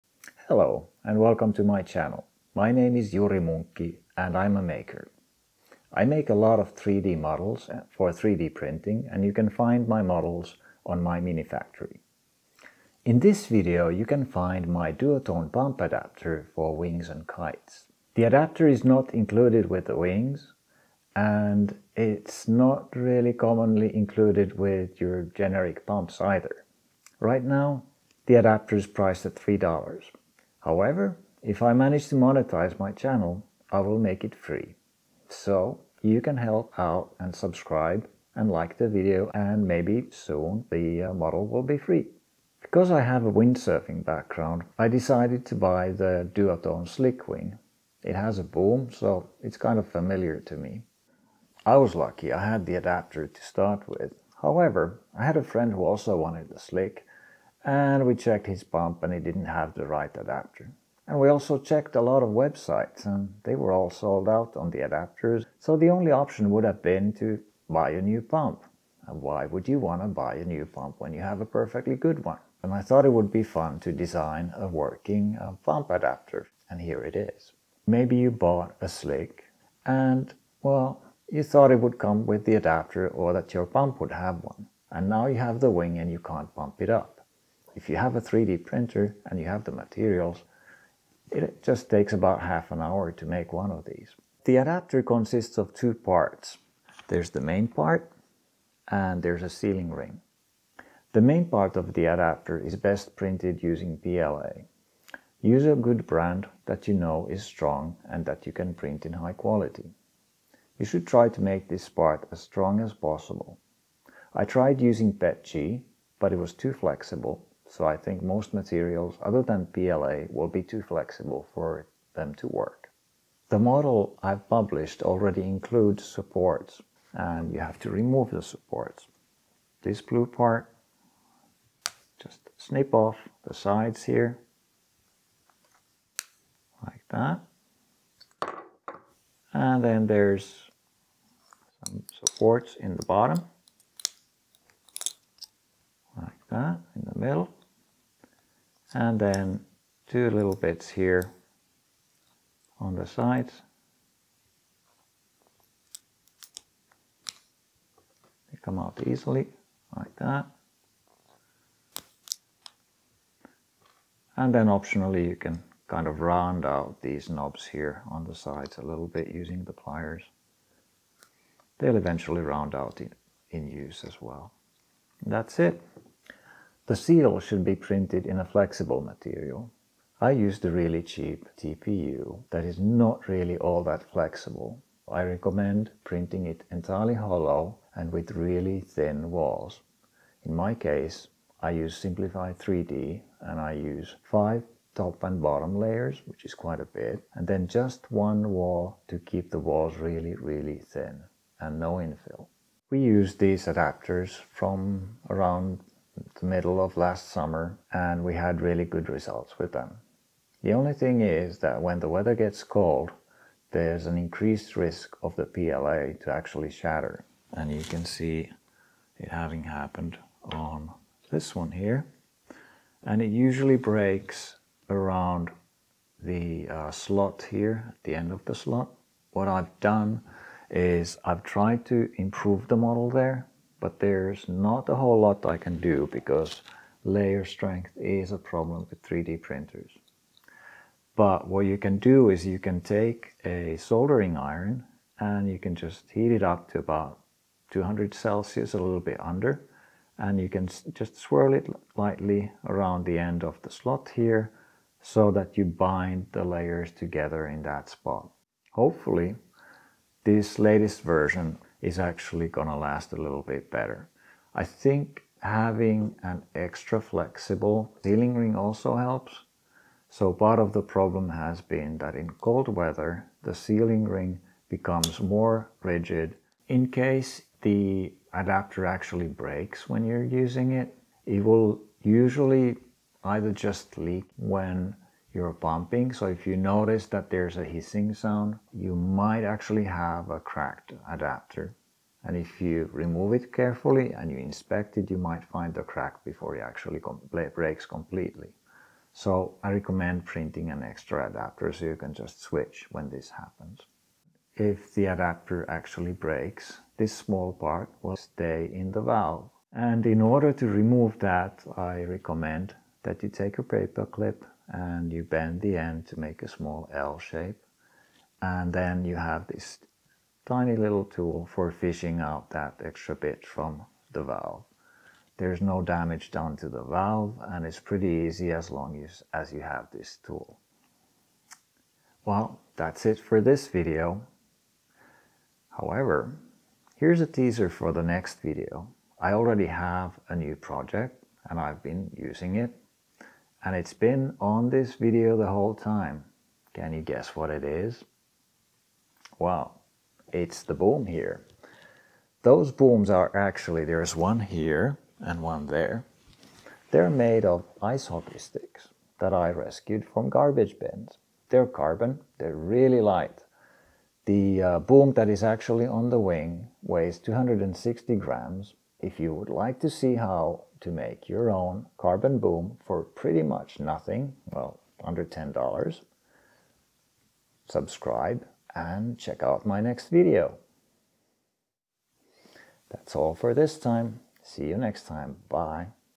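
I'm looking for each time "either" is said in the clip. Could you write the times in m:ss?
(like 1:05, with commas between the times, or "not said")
0:26, 4:43.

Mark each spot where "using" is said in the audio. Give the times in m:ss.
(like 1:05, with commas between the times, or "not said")
1:43, 1:54, 2:49, 4:40, 5:42.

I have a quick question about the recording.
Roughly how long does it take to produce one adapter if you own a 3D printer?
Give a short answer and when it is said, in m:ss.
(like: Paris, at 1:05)
half an hour, at 1:32.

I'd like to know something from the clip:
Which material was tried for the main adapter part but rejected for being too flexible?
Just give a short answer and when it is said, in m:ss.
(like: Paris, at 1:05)
PETG, at 1:55.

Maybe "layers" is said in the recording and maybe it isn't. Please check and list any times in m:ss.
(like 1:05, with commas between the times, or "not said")
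3:15, 3:57, 4:16.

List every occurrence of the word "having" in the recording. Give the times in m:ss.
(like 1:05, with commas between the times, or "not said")
3:39, 4:25.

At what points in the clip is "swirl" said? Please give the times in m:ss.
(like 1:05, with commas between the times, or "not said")
4:11.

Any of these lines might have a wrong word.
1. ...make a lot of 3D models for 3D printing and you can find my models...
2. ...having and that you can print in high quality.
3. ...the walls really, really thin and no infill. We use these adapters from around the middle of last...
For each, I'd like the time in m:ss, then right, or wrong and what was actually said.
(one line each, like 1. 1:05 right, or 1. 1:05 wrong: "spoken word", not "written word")
1. 0:06 right
2. 1:47 wrong: "strong", not "having"
3. 3:19 right.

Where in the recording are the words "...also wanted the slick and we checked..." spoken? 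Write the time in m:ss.
0:55.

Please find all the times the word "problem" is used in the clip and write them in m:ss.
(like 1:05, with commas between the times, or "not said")
3:58, 4:30.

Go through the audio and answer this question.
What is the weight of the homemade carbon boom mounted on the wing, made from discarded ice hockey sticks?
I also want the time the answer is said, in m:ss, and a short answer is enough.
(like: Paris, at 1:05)
260 grams, at 6:07.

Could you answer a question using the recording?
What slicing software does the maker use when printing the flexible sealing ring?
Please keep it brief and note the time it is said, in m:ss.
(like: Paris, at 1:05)
Simplify 3D, at 3:11.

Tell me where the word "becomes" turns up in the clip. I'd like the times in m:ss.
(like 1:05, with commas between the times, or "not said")
4:34.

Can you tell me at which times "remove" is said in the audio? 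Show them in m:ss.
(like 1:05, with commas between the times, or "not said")
2:07, 4:52, 5:10.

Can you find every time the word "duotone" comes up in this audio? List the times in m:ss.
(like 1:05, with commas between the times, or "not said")
0:14, 0:46.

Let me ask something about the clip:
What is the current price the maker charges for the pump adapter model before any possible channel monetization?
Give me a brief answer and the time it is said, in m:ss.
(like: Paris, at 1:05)
$3, at 0:29.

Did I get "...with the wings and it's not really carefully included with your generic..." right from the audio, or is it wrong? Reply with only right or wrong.
wrong.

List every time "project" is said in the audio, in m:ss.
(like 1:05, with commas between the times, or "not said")
5:40.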